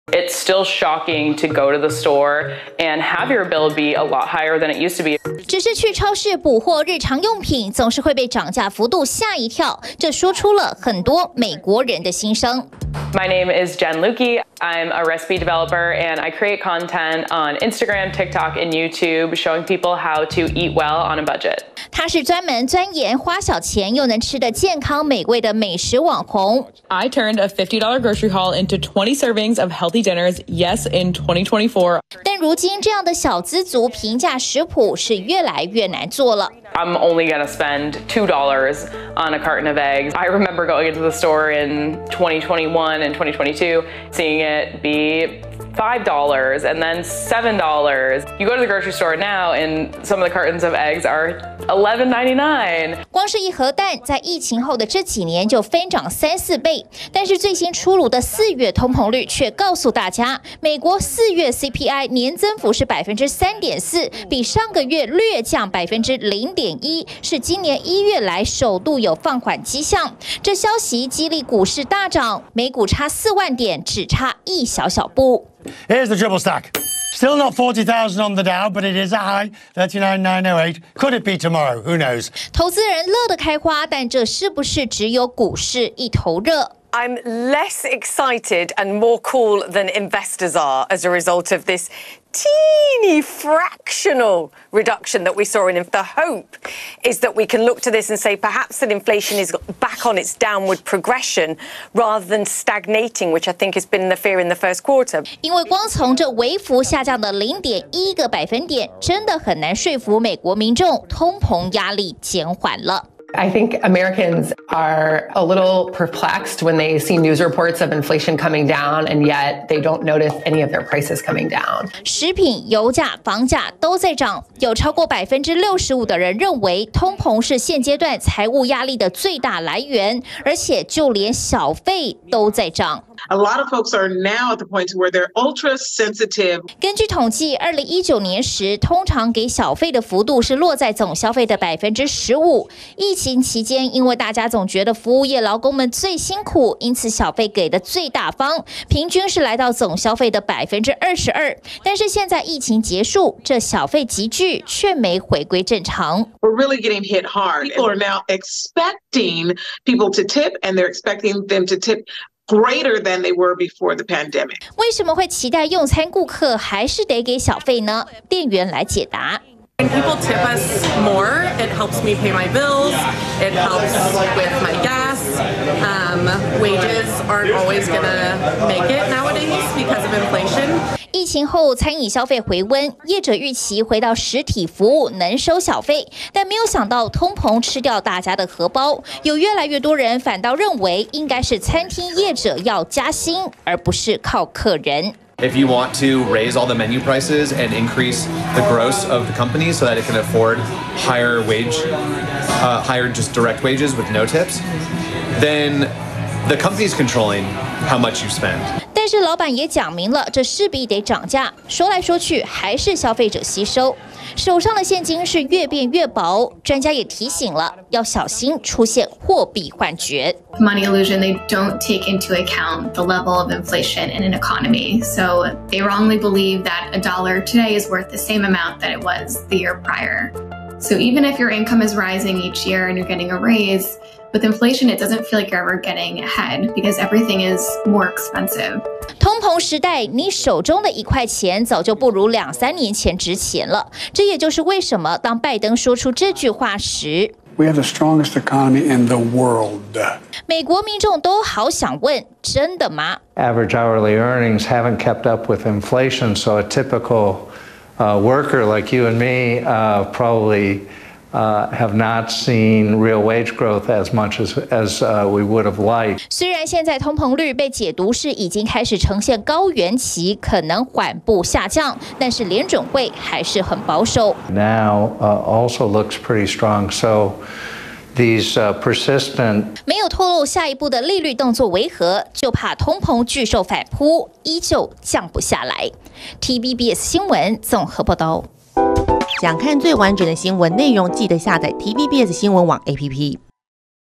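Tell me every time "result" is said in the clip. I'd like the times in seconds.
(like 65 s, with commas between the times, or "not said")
91 s.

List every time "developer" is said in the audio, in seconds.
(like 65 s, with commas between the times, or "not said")
15 s.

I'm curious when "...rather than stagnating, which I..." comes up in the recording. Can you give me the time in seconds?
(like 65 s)
101 s.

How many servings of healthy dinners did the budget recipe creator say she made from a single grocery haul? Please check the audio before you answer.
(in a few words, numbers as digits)
20.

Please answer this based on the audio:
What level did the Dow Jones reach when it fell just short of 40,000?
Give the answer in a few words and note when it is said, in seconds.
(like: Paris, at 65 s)
39,908, at 79 s.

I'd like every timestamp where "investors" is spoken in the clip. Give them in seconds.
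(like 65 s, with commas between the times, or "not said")
89 s.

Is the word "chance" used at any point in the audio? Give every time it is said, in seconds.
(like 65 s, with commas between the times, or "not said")
not said.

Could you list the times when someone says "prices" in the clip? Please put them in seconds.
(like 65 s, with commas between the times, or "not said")
120 s, 196 s.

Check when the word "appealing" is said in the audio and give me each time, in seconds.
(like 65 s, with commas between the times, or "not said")
not said.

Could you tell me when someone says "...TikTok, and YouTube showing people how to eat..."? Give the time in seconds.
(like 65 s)
18 s.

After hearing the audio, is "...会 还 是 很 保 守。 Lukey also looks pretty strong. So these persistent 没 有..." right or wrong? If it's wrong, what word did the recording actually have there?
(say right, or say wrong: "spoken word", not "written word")
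wrong: "Now", not "Lukey".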